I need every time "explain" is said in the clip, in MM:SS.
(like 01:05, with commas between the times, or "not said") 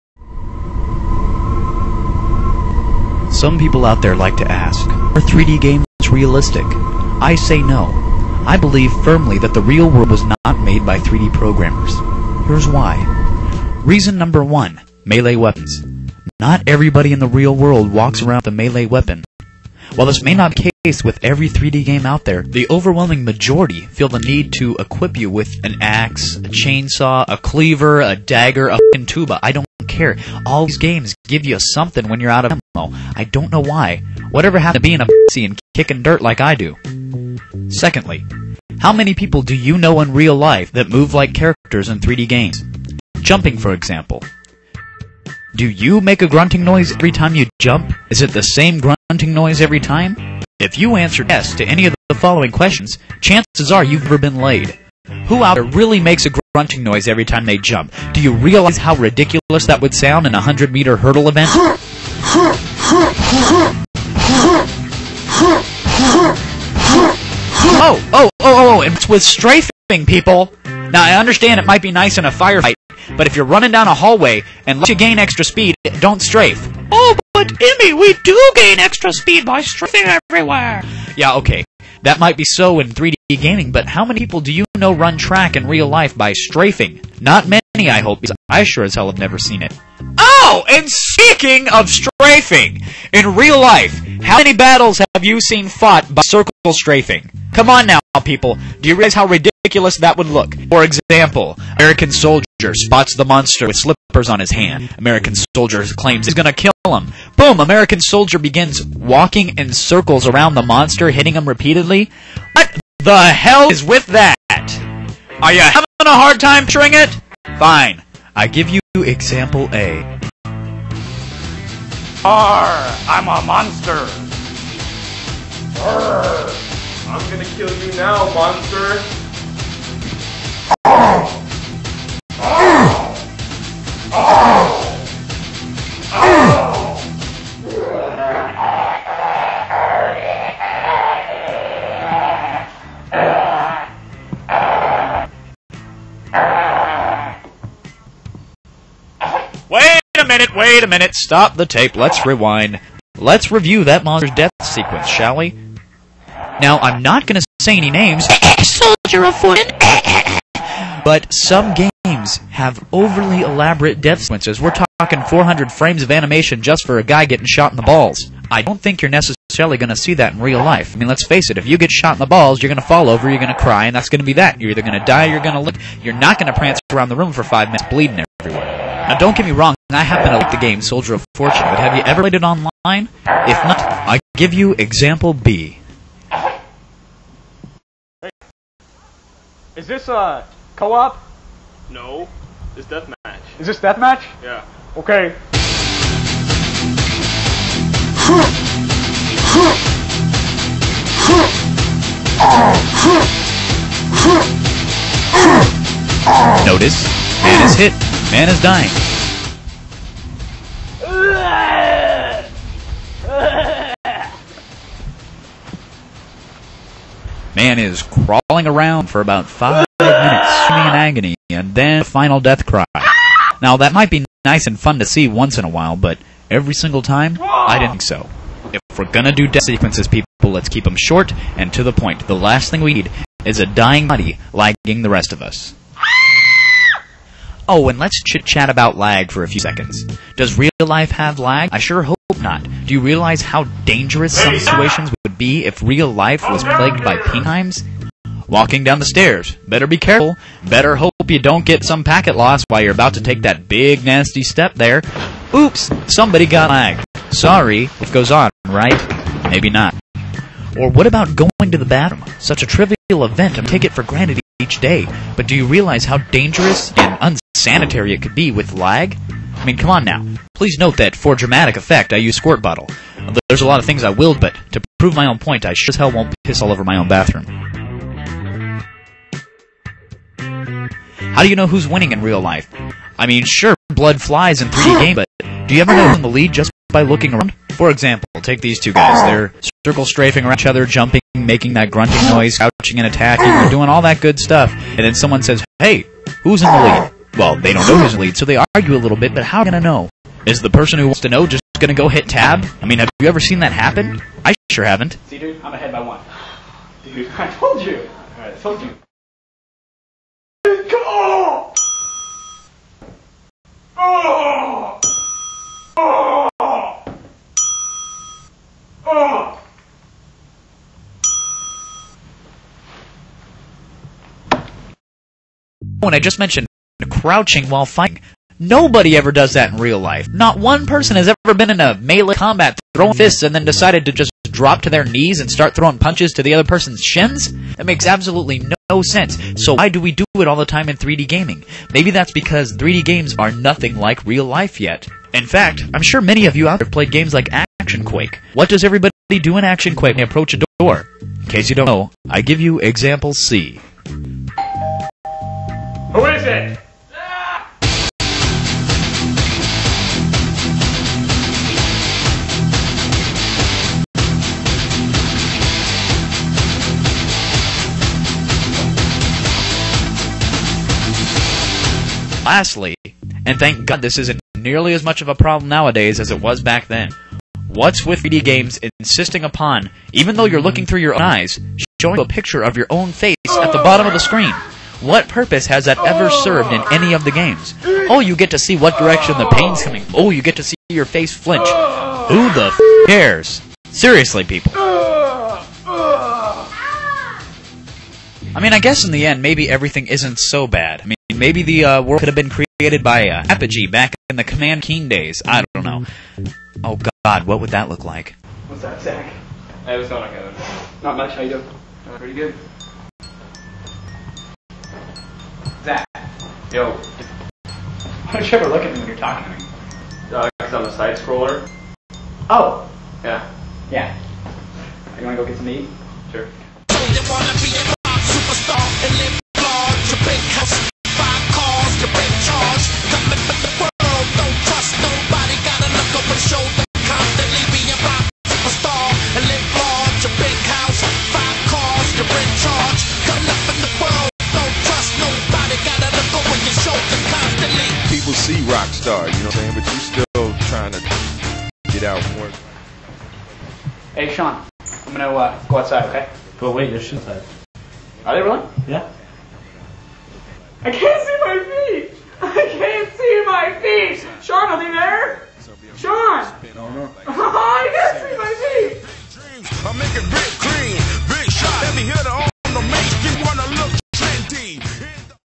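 not said.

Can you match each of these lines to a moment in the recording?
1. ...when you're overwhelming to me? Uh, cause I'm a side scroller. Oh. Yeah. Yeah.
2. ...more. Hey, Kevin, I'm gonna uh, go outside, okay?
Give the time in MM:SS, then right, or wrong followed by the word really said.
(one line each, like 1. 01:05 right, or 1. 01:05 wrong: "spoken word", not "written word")
1. 06:58 wrong: "talking", not "overwhelming"
2. 07:32 wrong: "Sean", not "Kevin".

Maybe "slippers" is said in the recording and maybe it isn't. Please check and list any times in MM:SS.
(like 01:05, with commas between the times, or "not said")
01:43.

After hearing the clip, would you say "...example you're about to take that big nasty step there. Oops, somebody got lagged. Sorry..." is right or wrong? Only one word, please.
wrong.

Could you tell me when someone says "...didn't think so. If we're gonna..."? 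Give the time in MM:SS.
03:47.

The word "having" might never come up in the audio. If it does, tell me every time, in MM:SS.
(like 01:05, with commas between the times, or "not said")
01:55.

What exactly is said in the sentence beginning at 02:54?
You're either going to die, you're going to look.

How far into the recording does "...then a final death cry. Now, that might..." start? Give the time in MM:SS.
03:41.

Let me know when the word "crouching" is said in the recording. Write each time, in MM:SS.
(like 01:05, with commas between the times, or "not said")
04:52, 05:27.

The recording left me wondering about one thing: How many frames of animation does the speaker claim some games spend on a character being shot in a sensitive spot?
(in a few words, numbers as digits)
400.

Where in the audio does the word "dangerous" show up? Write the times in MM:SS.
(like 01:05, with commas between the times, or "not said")
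04:03, 04:26.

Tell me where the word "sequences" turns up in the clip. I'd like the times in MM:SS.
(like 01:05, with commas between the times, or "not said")
02:34, 02:44, 03:49.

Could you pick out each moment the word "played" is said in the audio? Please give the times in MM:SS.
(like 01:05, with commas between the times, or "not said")
03:02, 05:46.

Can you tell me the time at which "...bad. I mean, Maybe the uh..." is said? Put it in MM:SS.
06:40.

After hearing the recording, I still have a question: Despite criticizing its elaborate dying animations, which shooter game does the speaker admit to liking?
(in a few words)
Soldier of Fortune.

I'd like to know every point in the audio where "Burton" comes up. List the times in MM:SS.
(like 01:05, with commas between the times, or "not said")
not said.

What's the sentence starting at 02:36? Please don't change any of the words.
Now, I'm not going to say any names.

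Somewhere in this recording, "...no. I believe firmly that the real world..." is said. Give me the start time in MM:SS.
00:07.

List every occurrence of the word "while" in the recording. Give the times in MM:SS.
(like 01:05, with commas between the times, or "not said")
00:19, 03:45, 04:12, 05:27.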